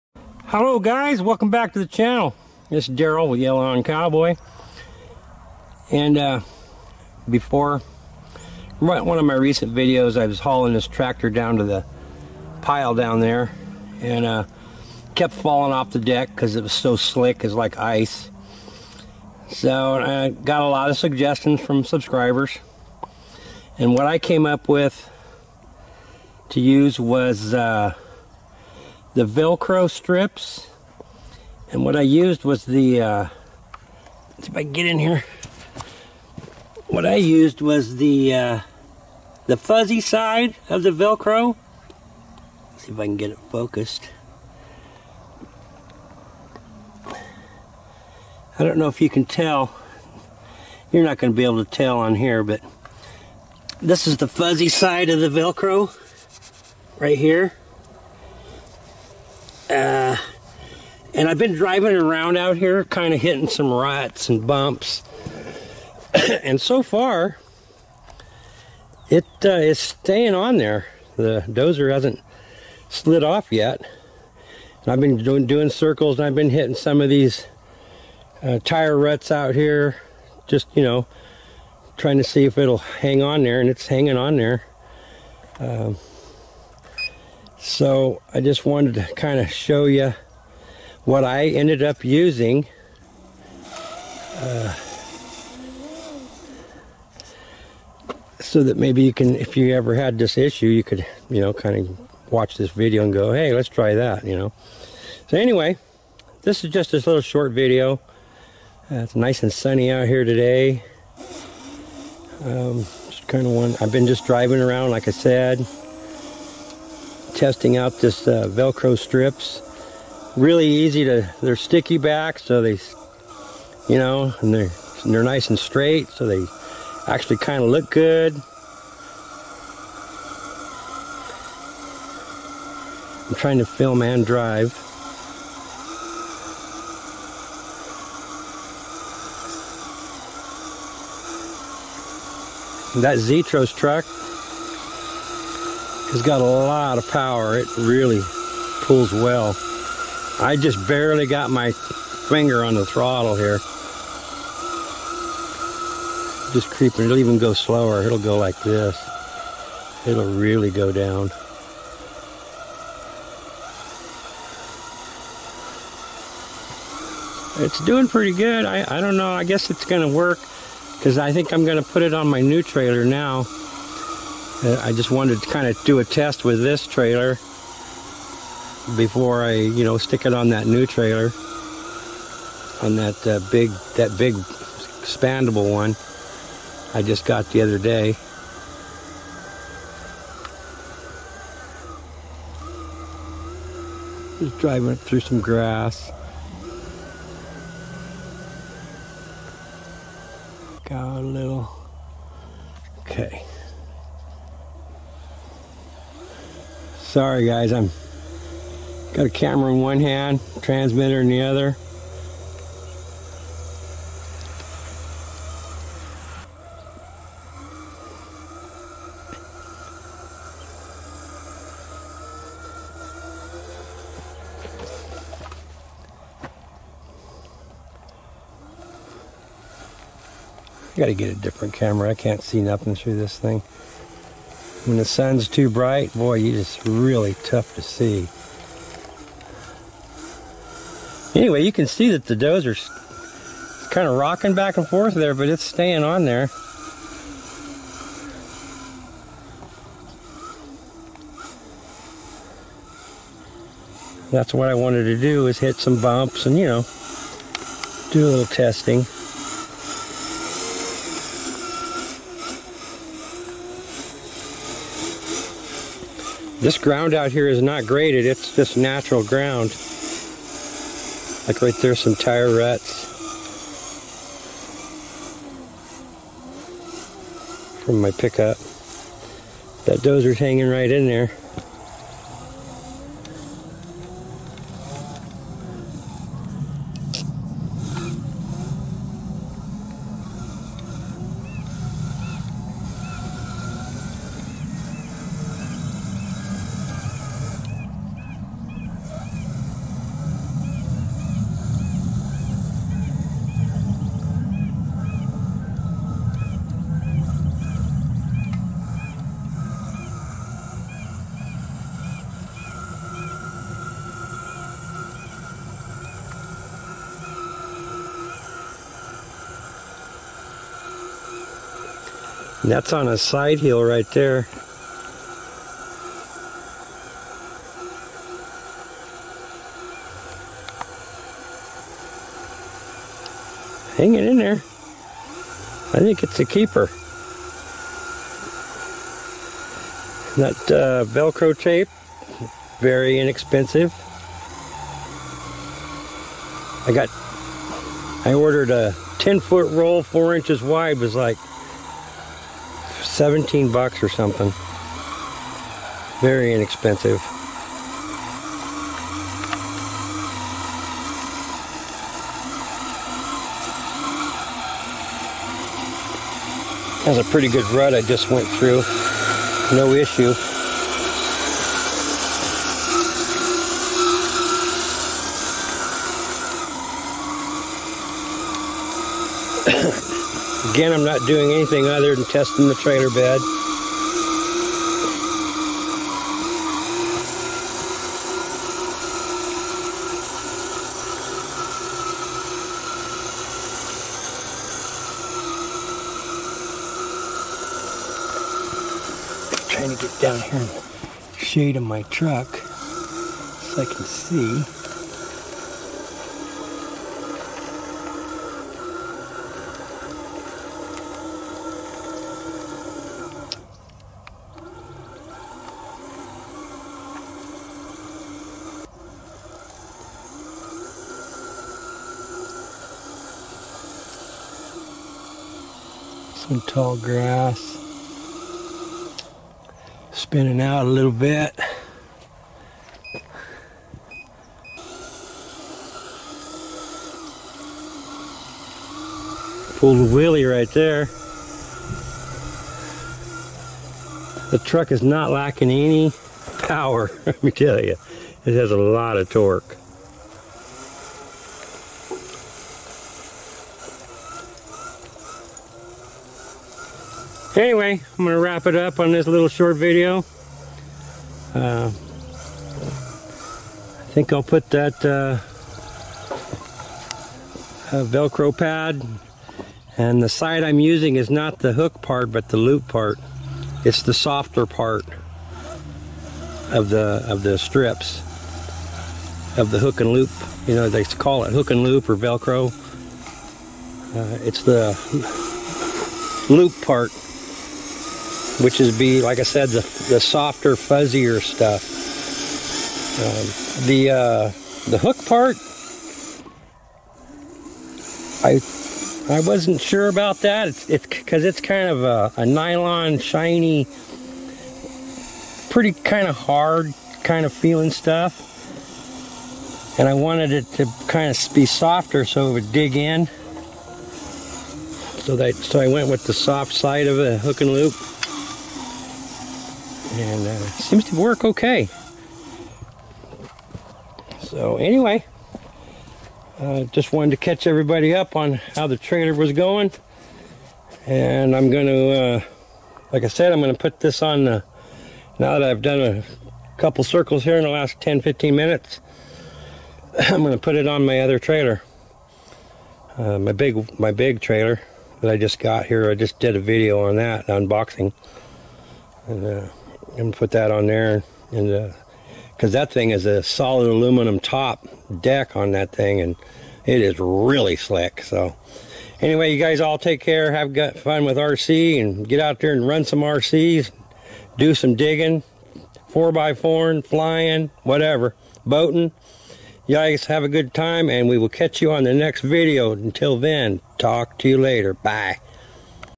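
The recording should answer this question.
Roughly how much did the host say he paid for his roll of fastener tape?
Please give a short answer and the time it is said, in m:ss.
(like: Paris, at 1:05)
$17, at 5:53.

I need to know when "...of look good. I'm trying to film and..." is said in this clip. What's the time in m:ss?
2:07.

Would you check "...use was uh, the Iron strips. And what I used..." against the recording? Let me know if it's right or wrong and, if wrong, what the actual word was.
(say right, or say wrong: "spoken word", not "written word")
wrong: "Velcro", not "Iron".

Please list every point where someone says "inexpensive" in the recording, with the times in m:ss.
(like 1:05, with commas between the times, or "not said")
5:43, 5:56.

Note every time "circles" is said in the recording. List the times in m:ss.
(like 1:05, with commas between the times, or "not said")
1:15, 8:57.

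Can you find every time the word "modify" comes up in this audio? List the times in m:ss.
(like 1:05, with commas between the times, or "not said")
not said.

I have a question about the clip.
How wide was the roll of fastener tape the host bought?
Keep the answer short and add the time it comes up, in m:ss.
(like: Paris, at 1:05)
4 inches, at 5:50.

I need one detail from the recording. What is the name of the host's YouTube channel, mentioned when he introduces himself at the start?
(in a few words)
Yellow Iron Cowboy.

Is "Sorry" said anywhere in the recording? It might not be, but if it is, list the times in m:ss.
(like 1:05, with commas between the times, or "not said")
3:27.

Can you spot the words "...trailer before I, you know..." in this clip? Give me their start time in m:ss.
2:56.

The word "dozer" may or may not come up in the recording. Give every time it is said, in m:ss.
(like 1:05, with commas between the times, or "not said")
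1:11, 4:02, 4:40.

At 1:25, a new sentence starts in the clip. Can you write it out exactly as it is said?
Um, so I just wanted to kind of show you what I ended up using.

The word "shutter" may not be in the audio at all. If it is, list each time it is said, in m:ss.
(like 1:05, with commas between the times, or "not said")
not said.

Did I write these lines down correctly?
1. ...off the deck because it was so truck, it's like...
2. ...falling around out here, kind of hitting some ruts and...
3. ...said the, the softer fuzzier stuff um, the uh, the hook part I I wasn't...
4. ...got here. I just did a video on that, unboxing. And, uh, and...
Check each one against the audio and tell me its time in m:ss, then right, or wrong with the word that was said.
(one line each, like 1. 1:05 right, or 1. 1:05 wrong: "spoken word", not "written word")
1. 0:15 wrong: "slick", not "truck"
2. 1:01 wrong: "driving", not "falling"
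3. 8:09 right
4. 9:05 right.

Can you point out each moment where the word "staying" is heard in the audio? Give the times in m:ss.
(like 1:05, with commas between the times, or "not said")
1:09, 4:05.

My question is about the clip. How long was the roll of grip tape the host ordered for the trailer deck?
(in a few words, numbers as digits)
10 foot.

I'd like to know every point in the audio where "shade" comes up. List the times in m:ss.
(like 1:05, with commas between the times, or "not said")
6:41.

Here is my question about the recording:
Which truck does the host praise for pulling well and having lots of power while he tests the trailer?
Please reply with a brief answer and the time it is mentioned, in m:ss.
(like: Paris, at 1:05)
Zetros, at 2:23.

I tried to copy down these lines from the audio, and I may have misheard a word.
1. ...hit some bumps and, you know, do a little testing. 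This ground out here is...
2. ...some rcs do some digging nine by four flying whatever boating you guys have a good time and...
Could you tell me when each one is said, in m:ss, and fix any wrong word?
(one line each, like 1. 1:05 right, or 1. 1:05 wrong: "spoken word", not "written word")
1. 4:15 right
2. 9:23 wrong: "four", not "nine".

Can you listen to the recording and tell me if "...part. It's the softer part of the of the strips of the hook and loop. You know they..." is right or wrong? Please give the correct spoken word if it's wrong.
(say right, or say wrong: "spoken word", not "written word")
right.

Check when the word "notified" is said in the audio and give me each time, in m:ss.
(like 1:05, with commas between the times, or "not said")
not said.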